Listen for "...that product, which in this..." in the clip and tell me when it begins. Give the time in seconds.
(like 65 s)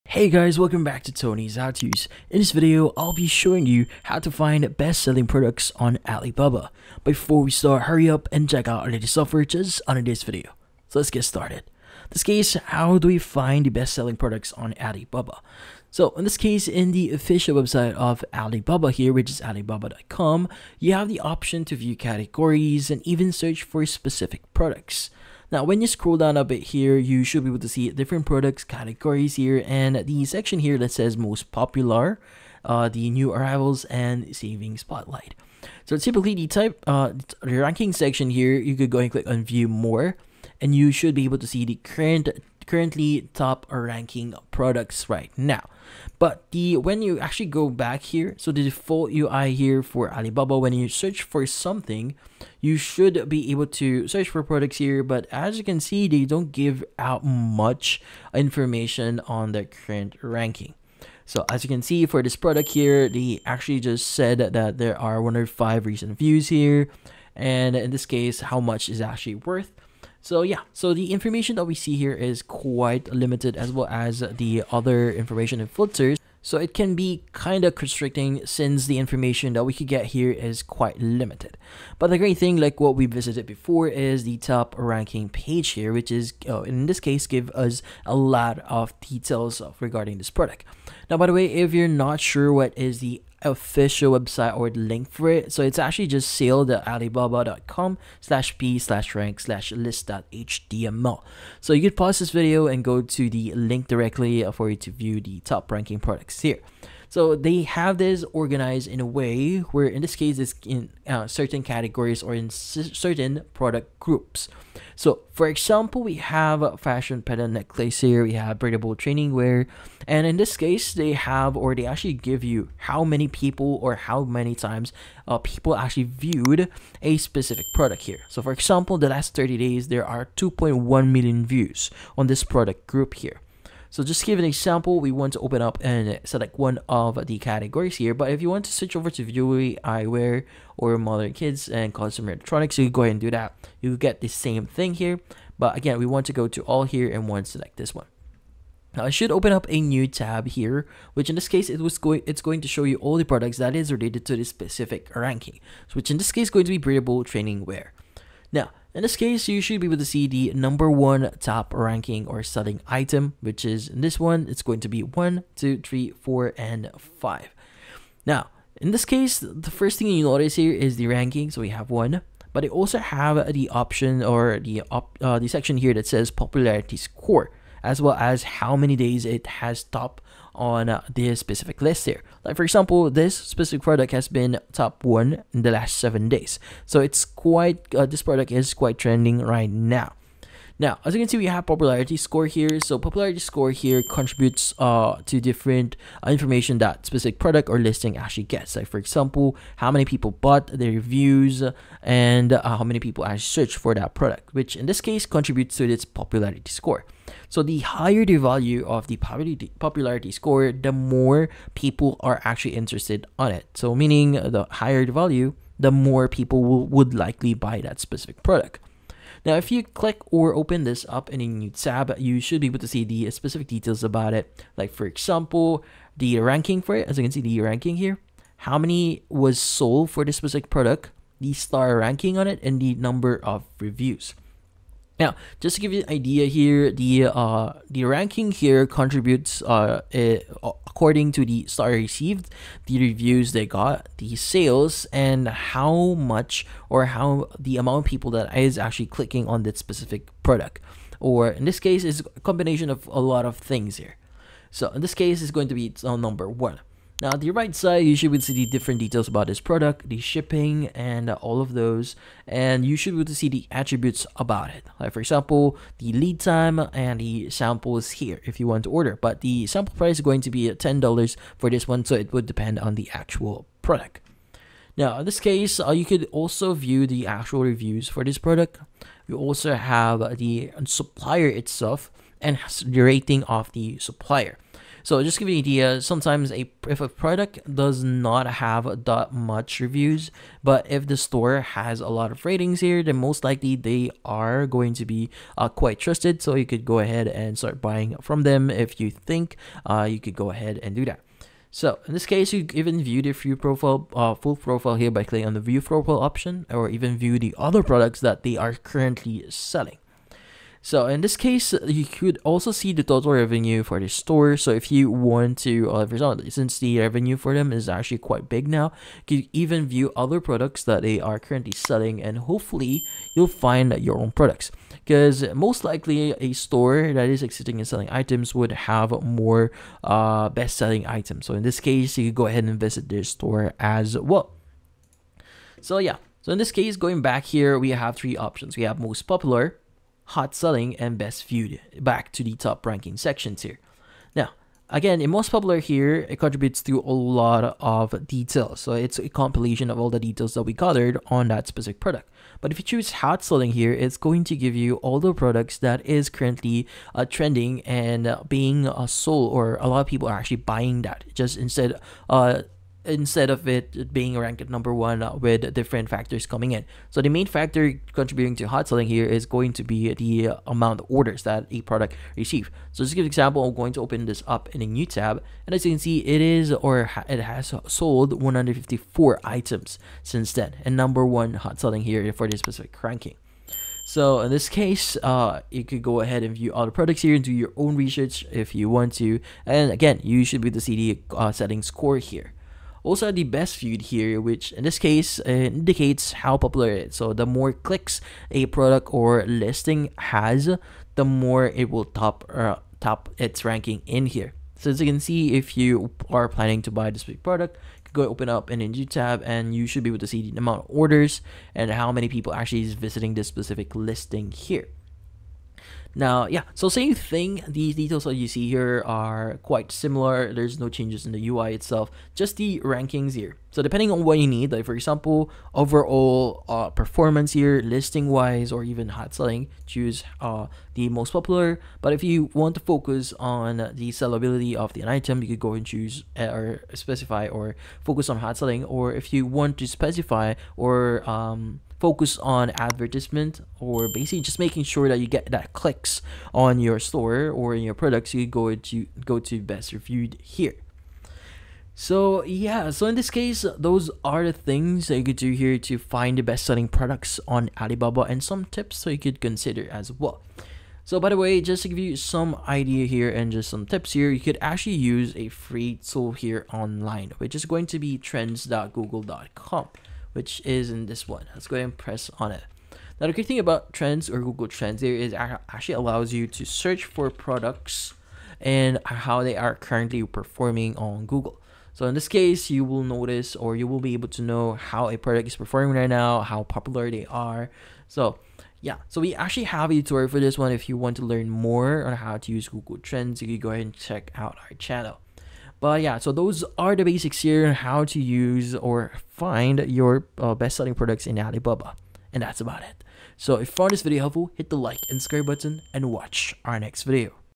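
203 s.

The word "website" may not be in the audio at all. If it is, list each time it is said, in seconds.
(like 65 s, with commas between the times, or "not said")
17 s, 94 s.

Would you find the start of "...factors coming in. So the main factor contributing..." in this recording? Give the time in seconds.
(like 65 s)
366 s.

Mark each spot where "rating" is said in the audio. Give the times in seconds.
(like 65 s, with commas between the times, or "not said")
283 s, 292 s.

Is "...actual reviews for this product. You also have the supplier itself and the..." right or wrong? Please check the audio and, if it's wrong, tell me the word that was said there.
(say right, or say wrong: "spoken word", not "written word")
right.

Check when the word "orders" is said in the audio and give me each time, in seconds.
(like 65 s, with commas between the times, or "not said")
268 s, 371 s, 410 s.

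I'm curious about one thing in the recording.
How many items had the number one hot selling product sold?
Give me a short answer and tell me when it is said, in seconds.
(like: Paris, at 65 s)
154, at 378 s.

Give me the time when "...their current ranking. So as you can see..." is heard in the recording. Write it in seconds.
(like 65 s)
59 s.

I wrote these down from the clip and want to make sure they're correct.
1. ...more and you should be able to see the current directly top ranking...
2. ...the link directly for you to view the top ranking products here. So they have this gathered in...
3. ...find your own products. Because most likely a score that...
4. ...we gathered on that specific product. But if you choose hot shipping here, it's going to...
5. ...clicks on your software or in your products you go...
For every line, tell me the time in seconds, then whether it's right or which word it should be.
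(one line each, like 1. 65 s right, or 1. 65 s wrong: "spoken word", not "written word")
1. 39 s wrong: "currently", not "directly"
2. 103 s wrong: "organized", not "gathered"
3. 323 s wrong: "store", not "score"
4. 350 s wrong: "selling", not "shipping"
5. 445 s wrong: "store", not "software".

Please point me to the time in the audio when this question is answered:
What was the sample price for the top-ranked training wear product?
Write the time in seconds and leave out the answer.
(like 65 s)
270 s.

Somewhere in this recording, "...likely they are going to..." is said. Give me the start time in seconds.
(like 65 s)
293 s.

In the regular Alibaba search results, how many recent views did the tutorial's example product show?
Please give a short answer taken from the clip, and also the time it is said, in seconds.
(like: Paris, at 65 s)
105, at 65 s.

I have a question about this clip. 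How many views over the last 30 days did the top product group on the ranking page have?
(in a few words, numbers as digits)
2.1 million.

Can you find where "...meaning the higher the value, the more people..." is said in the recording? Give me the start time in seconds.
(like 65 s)
213 s.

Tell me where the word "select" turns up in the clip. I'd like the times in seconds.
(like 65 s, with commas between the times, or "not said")
136 s, 147 s.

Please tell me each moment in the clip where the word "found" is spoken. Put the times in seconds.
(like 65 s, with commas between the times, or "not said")
503 s.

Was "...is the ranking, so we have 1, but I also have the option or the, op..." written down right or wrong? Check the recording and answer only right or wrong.
right.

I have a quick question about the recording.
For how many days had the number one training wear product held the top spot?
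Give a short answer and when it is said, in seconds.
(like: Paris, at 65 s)
7 days, at 185 s.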